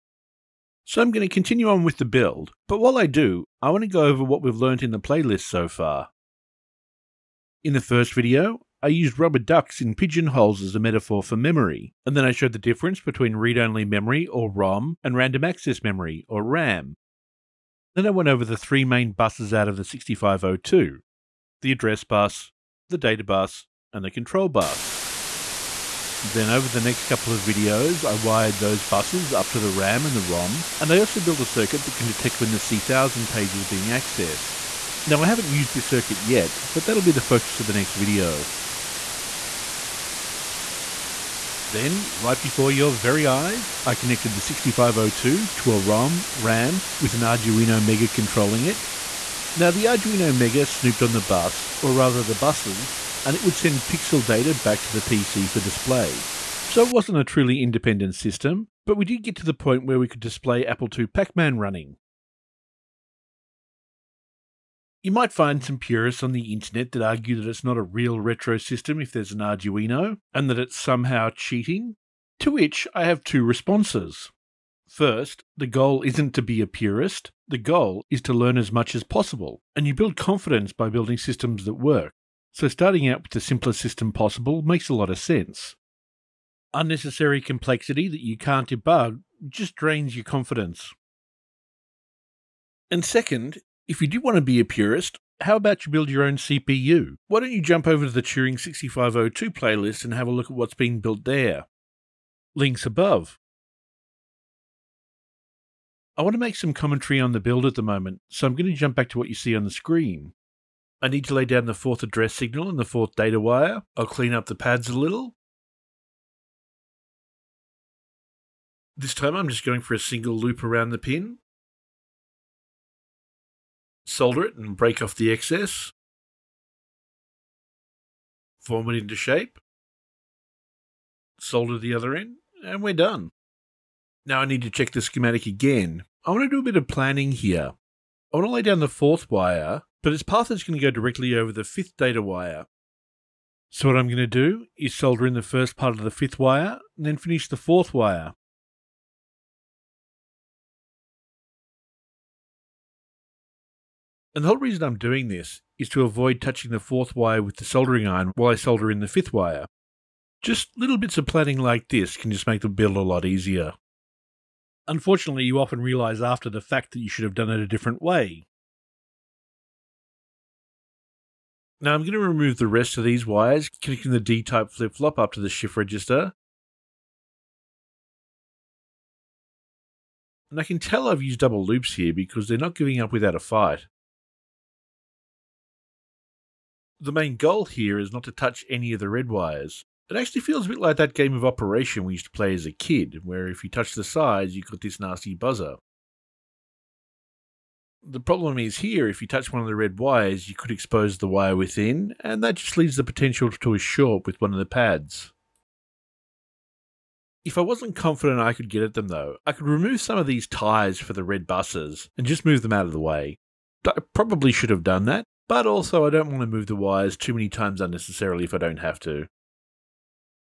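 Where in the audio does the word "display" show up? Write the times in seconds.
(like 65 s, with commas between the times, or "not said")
55 s, 60 s.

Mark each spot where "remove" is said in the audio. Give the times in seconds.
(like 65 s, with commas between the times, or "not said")
172 s, 209 s.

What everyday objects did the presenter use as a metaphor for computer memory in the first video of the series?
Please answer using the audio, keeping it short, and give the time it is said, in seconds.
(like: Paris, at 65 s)
Rubber ducks in pigeonholes, at 9 s.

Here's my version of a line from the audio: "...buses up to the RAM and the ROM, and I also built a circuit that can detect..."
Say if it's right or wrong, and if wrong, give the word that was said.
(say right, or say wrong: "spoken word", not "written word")
right.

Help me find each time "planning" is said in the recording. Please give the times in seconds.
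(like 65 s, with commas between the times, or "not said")
136 s, 161 s.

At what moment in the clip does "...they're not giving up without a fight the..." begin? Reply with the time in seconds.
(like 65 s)
182 s.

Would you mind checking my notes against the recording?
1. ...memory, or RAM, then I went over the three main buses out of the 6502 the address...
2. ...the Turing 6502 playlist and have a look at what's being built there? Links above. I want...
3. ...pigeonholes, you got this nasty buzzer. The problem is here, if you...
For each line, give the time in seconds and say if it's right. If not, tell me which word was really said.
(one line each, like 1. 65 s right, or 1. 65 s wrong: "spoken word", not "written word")
1. 15 s right
2. 98 s right
3. 194 s wrong: "sides", not "pigeonholes".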